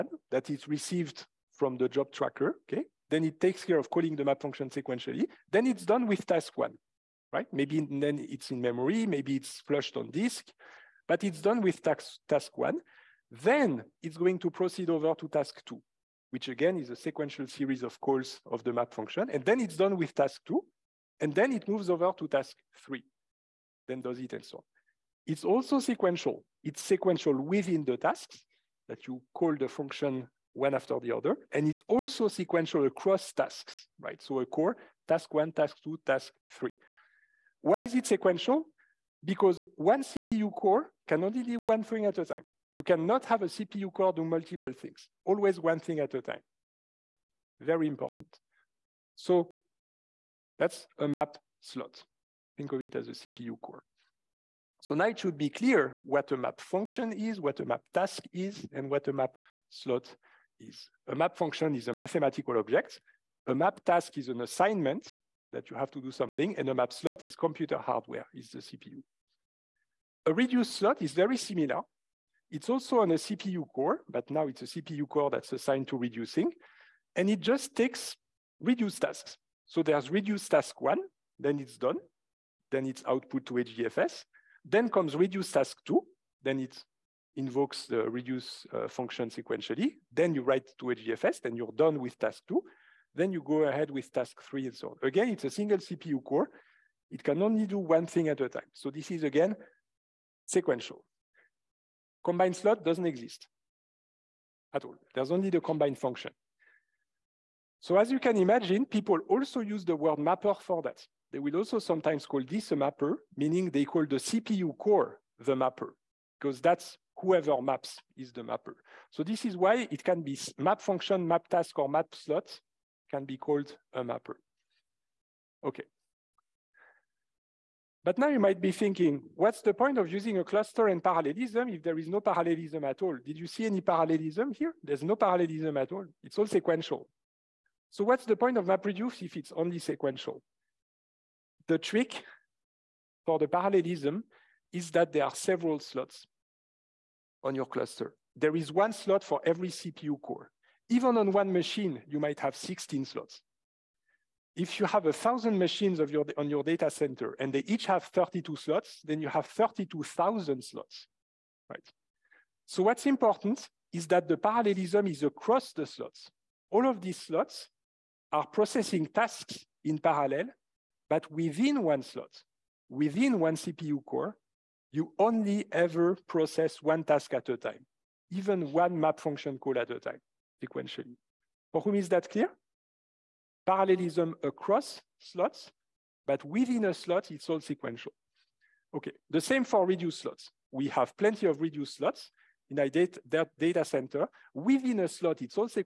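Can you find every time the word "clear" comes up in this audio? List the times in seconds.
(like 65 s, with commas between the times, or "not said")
55 s, 182 s.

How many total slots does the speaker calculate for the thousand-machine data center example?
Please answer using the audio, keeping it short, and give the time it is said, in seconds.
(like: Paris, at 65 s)
32,000, at 159 s.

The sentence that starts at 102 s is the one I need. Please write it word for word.
Combined slot doesn't exist at all.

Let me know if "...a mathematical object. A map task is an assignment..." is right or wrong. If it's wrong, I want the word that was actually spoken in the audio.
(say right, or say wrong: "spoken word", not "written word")
right.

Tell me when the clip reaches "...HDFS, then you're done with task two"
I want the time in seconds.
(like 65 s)
90 s.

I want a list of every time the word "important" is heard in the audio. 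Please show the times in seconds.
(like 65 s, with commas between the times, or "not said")
47 s, 163 s.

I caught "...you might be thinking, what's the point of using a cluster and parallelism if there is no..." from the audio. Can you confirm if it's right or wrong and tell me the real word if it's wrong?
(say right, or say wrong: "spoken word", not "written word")
right.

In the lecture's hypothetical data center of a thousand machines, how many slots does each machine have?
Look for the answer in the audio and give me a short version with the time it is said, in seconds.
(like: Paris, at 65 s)
32, at 158 s.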